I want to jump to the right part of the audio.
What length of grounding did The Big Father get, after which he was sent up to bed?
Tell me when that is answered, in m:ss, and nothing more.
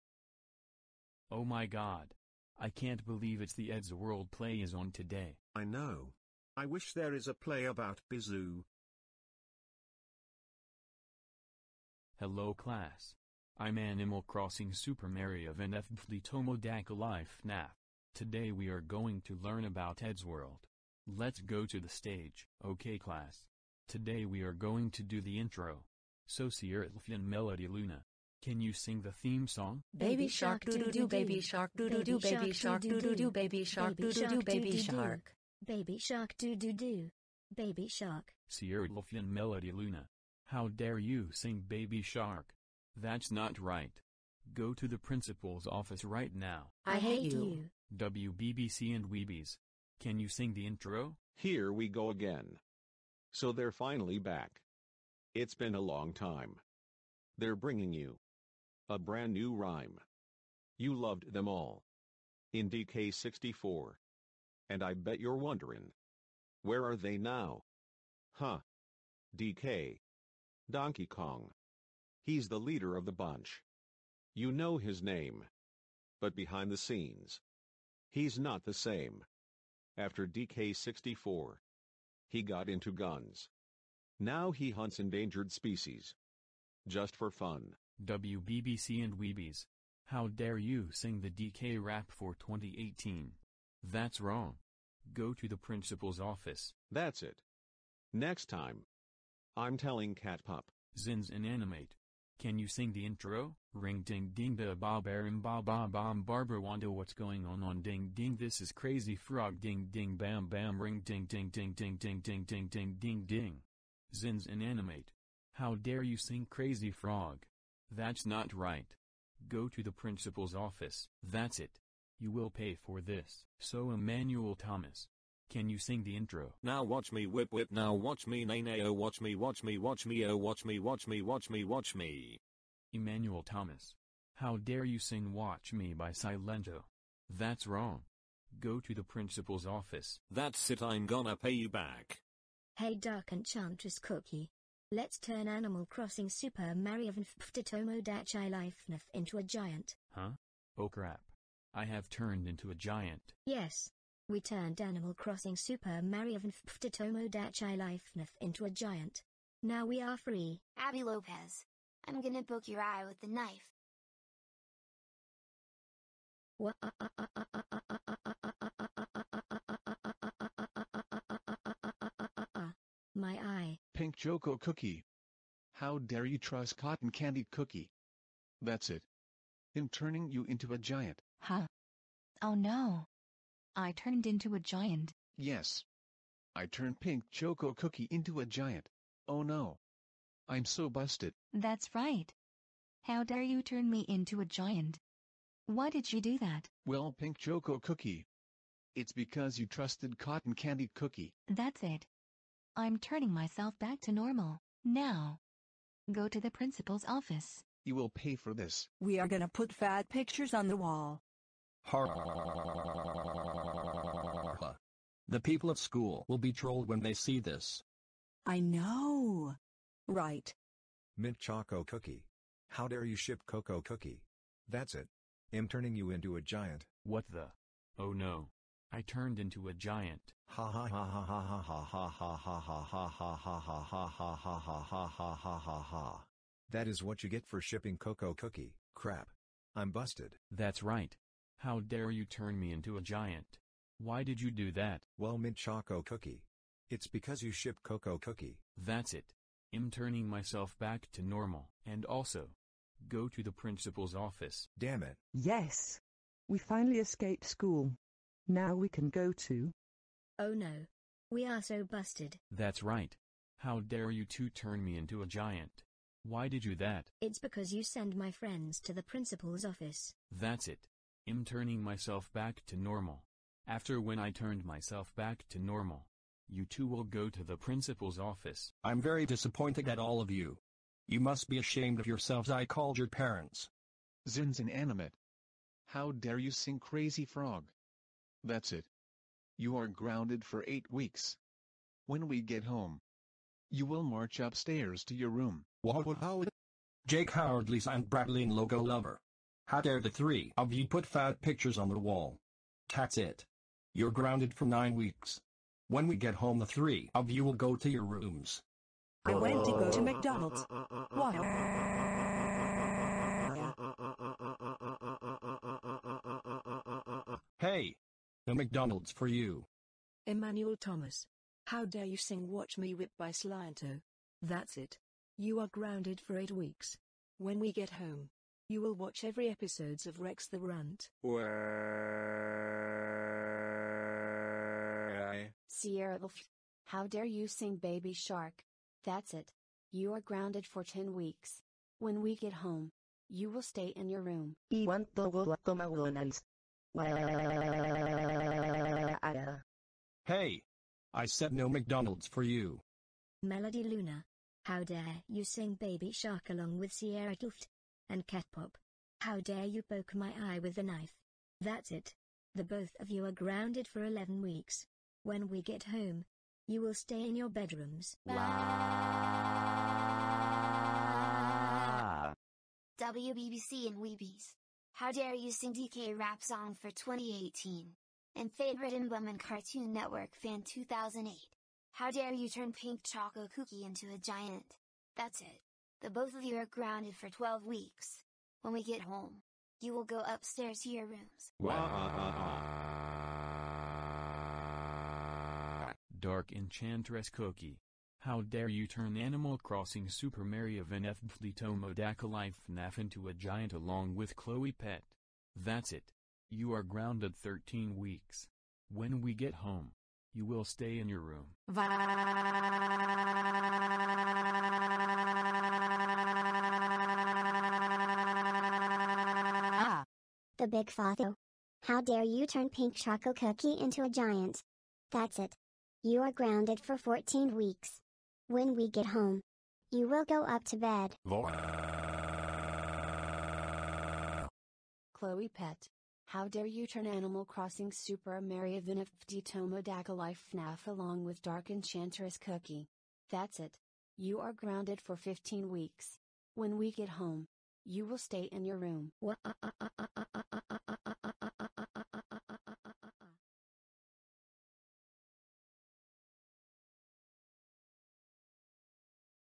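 7:06.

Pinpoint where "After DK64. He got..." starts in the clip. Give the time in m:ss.
1:19.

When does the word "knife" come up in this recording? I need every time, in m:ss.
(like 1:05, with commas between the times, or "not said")
2:43, 6:00.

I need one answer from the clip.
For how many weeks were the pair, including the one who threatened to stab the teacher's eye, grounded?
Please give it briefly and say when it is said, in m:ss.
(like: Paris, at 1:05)
11, at 6:04.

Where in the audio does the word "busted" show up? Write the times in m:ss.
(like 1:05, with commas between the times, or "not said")
3:10, 4:21.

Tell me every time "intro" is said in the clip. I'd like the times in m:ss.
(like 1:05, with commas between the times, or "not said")
0:25, 0:50, 1:43, 2:06.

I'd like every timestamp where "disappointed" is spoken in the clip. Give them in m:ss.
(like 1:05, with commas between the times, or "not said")
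4:39.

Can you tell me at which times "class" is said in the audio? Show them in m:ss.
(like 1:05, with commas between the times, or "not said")
0:12, 0:22.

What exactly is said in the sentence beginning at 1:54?
Zins Animate, How dare you sing crazy frog?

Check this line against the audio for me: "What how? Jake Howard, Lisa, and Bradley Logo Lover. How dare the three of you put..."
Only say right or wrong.
right.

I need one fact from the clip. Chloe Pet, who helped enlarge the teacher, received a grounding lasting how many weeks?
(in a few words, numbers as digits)
15.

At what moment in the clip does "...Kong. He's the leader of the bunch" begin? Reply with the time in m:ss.
1:11.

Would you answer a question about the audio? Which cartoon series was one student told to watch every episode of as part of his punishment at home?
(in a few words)
Rex the Runt.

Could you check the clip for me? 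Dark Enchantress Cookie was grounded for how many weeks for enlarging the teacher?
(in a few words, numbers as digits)
13.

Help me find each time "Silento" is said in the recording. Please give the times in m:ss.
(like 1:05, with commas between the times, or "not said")
2:16, 5:23.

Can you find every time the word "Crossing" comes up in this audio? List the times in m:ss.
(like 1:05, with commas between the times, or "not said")
0:14, 2:25, 2:35, 6:39, 7:17.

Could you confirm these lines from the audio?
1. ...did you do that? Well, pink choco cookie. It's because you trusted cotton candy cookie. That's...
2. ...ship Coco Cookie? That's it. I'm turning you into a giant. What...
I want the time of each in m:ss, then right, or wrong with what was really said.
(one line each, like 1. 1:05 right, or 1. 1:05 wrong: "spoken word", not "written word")
1. 3:15 right
2. 3:43 right.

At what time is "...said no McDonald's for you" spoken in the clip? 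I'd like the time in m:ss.
5:51.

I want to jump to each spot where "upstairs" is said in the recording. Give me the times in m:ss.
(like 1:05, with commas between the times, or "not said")
4:54, 6:30.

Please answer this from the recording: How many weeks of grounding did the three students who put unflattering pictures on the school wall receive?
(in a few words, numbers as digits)
9.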